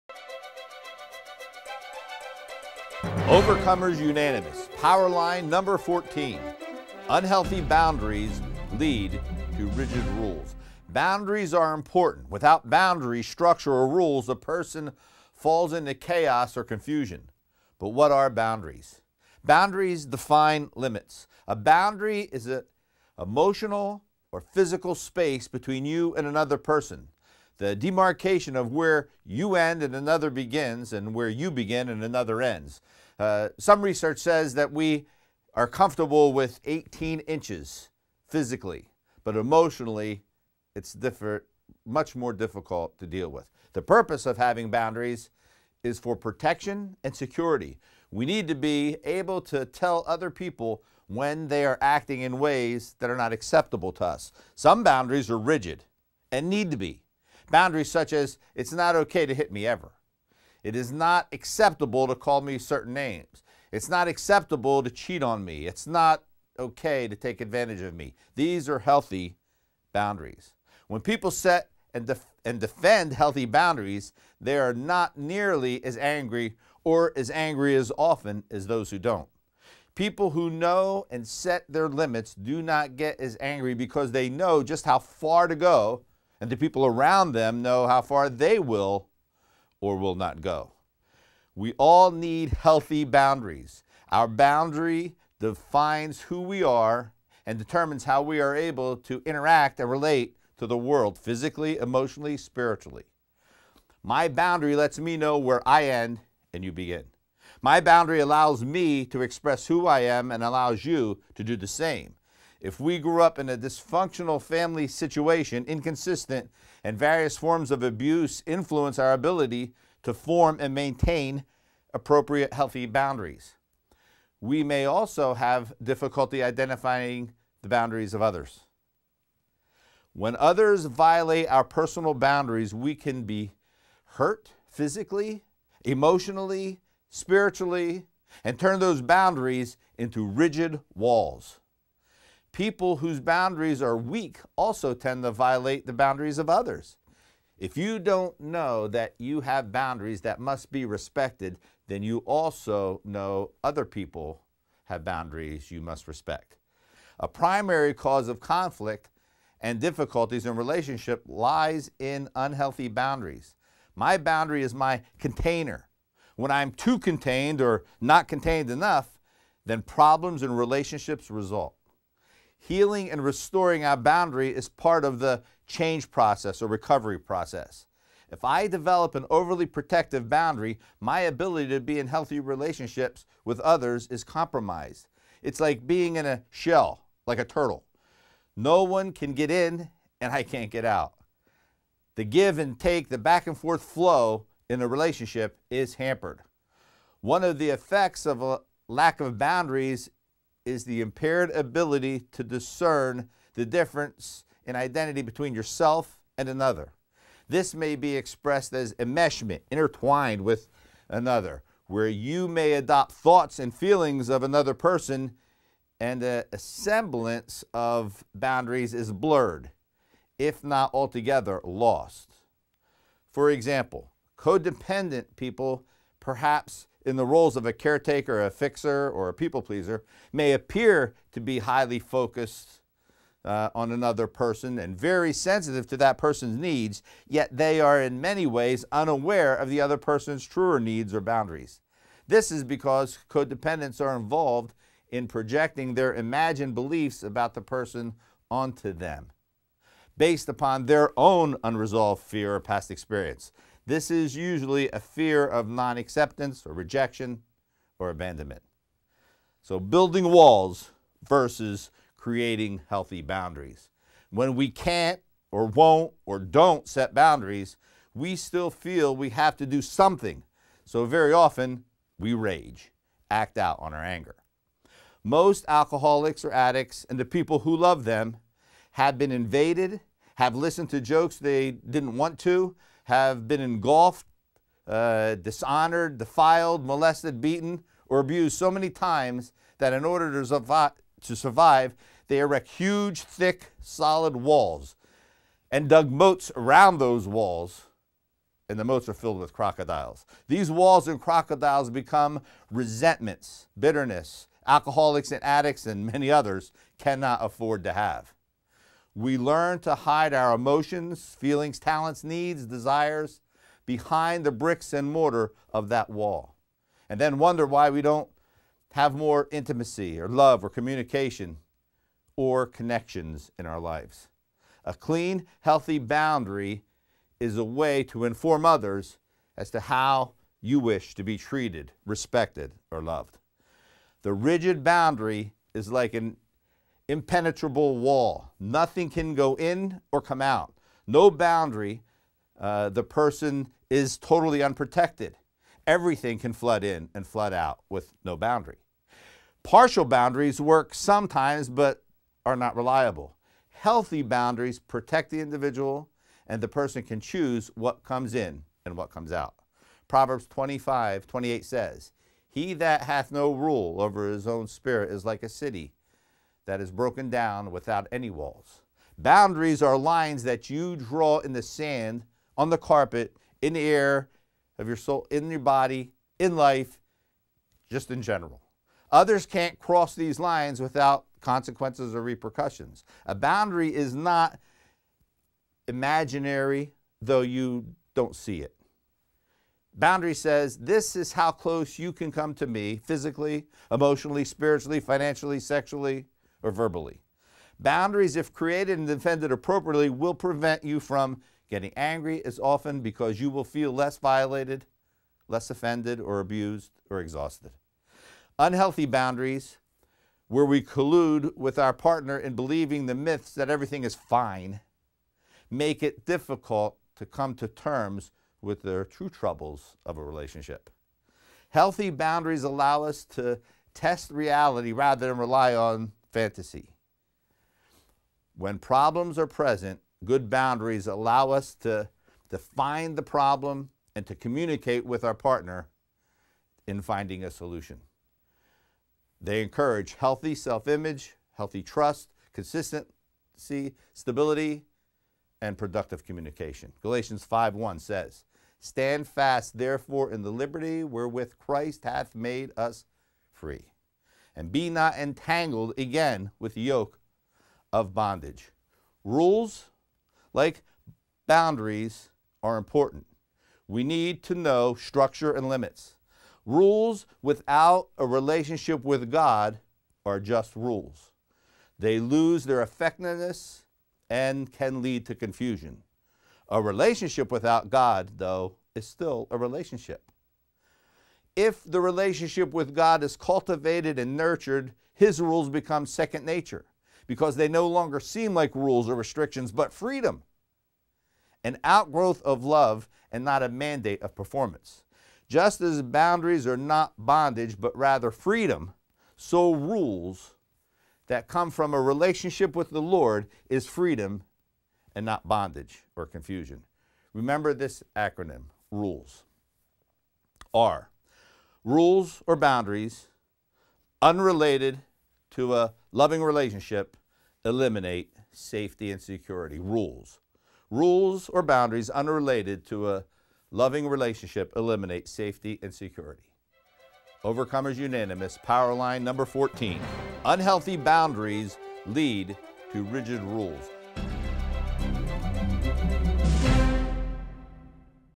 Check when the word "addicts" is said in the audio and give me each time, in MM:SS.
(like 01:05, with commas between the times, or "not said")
04:36, 05:05.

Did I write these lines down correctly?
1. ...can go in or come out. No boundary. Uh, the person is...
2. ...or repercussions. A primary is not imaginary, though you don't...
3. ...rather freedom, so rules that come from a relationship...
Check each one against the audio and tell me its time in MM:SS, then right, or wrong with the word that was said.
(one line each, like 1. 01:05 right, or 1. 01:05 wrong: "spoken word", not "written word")
1. 05:39 right
2. 06:22 wrong: "boundary", not "primary"
3. 08:17 right.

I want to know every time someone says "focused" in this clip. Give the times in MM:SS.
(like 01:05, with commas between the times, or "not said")
03:51.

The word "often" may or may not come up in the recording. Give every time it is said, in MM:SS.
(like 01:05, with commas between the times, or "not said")
01:17, 04:31, 06:42.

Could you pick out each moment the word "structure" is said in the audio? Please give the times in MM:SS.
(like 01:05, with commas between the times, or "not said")
00:13, 07:44.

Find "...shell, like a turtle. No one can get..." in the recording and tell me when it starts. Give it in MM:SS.
03:06.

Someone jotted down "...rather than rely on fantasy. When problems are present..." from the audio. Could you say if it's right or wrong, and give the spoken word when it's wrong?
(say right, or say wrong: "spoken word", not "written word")
right.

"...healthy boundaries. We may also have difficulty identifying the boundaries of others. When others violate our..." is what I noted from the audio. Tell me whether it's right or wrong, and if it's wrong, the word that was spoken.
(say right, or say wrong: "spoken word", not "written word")
right.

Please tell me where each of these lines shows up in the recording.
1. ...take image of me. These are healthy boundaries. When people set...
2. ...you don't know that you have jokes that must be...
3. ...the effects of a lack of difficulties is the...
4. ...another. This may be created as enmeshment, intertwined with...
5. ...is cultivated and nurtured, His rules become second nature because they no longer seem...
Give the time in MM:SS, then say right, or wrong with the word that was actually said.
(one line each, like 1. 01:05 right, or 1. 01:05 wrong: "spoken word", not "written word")
1. 01:07 wrong: "advantage", not "image"
2. 02:27 wrong: "boundaries", not "jokes"
3. 03:17 wrong: "boundaries", not "difficulties"
4. 03:26 wrong: "expressed", not "created"
5. 08:03 right.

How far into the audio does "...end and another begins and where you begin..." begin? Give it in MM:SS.
00:29.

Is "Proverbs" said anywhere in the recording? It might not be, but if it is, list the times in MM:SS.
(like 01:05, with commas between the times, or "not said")
06:00.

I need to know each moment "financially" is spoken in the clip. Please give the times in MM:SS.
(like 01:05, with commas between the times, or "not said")
06:35.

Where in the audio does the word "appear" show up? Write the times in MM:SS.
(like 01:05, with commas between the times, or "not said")
03:50.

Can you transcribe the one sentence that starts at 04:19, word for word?
So, building walls versus creating healthy boundaries.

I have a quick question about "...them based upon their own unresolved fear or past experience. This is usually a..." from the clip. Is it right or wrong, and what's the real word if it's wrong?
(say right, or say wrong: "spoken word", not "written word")
right.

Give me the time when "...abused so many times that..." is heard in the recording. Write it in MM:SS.
04:48.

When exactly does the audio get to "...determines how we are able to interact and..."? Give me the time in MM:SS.
01:37.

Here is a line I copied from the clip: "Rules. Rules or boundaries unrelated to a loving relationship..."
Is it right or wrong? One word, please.
right.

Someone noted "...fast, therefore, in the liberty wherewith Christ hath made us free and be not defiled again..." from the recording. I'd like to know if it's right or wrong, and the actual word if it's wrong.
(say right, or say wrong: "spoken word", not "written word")
wrong: "entangled", not "defiled".